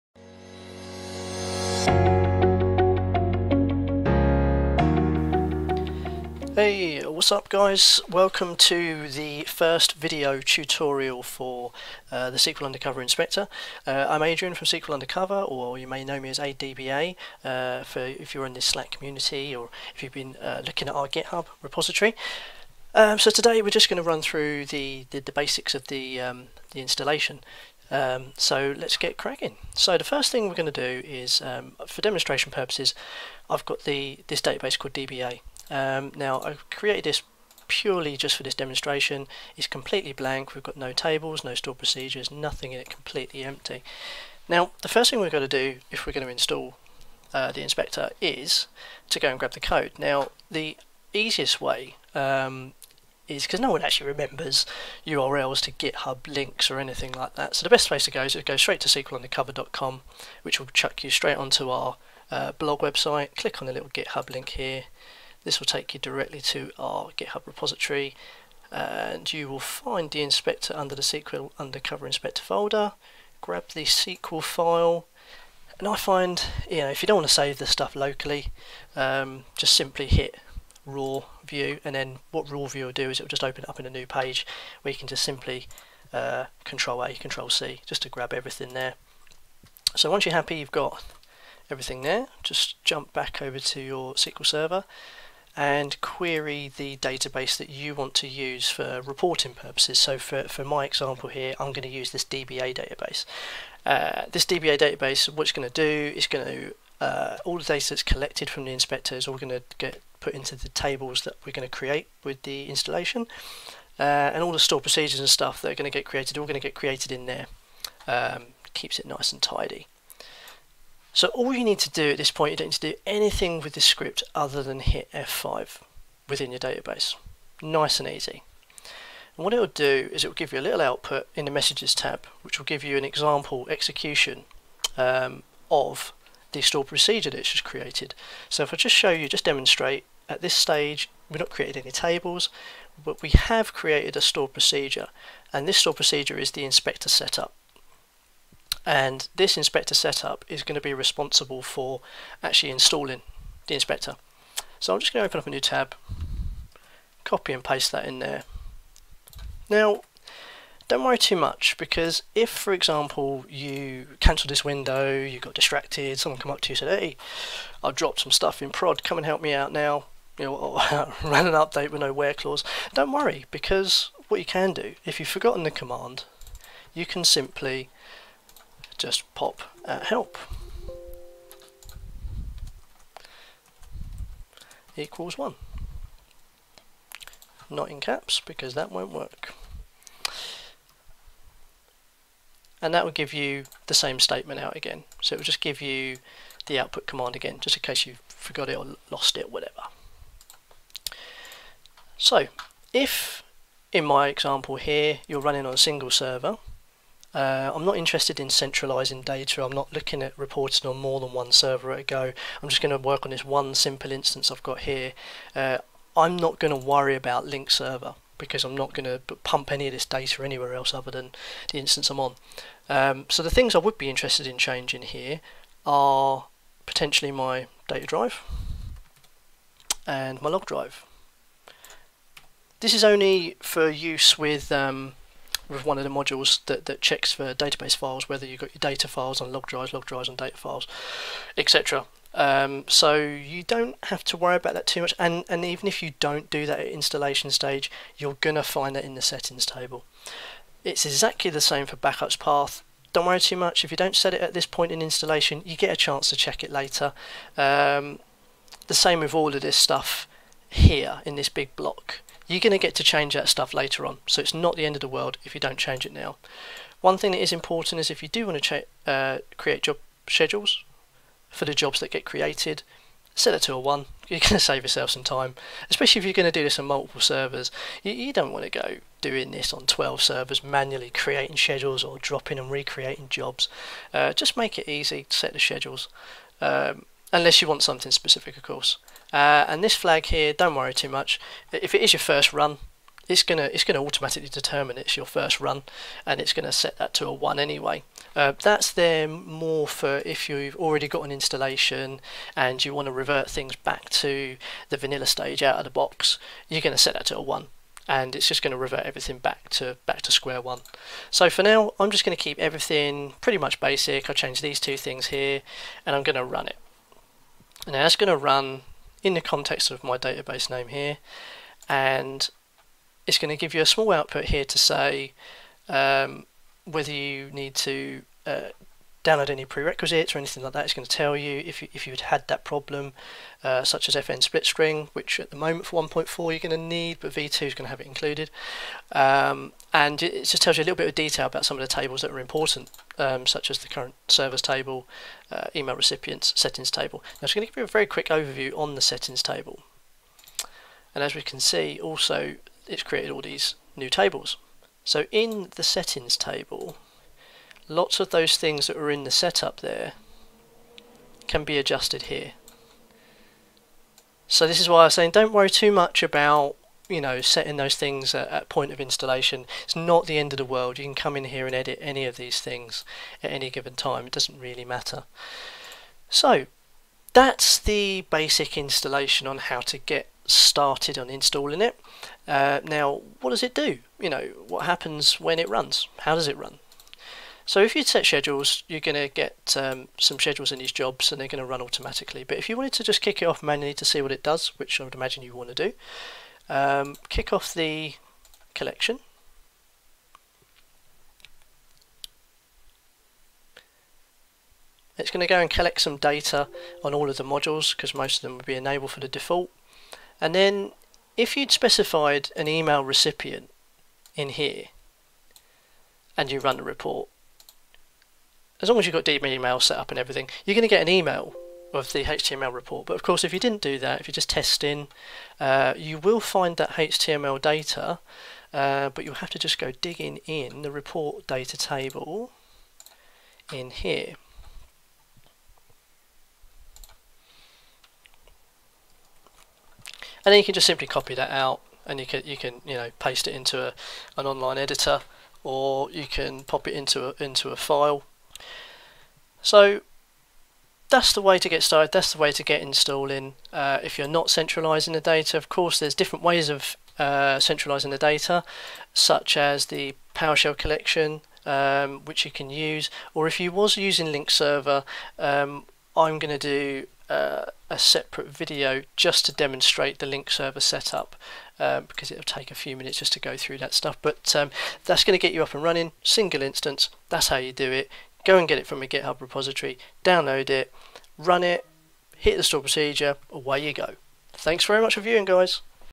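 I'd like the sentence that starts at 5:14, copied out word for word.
i change these two things here, and I'm going to run it.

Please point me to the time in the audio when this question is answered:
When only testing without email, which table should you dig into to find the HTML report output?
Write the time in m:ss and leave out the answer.
7:10.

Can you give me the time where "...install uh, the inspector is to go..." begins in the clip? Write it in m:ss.
0:46.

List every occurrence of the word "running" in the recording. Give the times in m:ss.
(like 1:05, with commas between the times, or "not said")
3:25, 7:55.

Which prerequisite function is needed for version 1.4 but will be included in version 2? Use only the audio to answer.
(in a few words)
FN split string.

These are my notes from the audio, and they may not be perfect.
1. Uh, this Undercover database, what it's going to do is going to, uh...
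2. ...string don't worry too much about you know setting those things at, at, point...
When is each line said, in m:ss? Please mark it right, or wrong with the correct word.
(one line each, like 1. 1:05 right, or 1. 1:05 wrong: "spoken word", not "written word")
1. 1:43 wrong: "DBA", not "Undercover"
2. 6:05 wrong: "saying", not "string".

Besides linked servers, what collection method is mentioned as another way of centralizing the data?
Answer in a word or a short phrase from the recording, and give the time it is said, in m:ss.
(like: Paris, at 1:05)
PowerShell collection, at 7:40.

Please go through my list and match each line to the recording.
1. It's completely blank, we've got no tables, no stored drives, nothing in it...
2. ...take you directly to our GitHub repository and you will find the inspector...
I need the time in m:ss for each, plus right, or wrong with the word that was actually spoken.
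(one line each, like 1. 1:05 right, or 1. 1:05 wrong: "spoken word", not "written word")
1. 0:39 wrong: "procedures", not "drives"
2. 1:05 right.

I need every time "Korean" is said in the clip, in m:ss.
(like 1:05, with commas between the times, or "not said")
not said.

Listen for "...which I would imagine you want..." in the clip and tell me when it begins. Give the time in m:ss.
6:34.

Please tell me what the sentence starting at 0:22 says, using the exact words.
Um, so today we're just going to run through the, the, the basics of the, um, the installation.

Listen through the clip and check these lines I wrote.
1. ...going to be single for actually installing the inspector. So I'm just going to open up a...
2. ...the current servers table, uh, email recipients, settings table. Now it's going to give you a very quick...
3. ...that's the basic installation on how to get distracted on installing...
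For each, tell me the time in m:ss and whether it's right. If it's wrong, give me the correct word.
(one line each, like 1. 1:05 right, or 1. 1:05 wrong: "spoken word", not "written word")
1. 2:30 wrong: "responsible", not "single"
2. 5:43 right
3. 6:17 wrong: "started", not "distracted".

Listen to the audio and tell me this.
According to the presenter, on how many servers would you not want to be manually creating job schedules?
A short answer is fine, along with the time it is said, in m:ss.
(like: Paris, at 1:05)
12, at 4:39.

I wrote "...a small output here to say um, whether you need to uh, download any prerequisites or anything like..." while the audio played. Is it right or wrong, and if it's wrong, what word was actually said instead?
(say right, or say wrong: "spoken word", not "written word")
right.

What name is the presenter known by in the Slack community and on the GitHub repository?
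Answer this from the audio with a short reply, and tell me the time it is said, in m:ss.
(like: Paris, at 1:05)
ADBA, at 0:16.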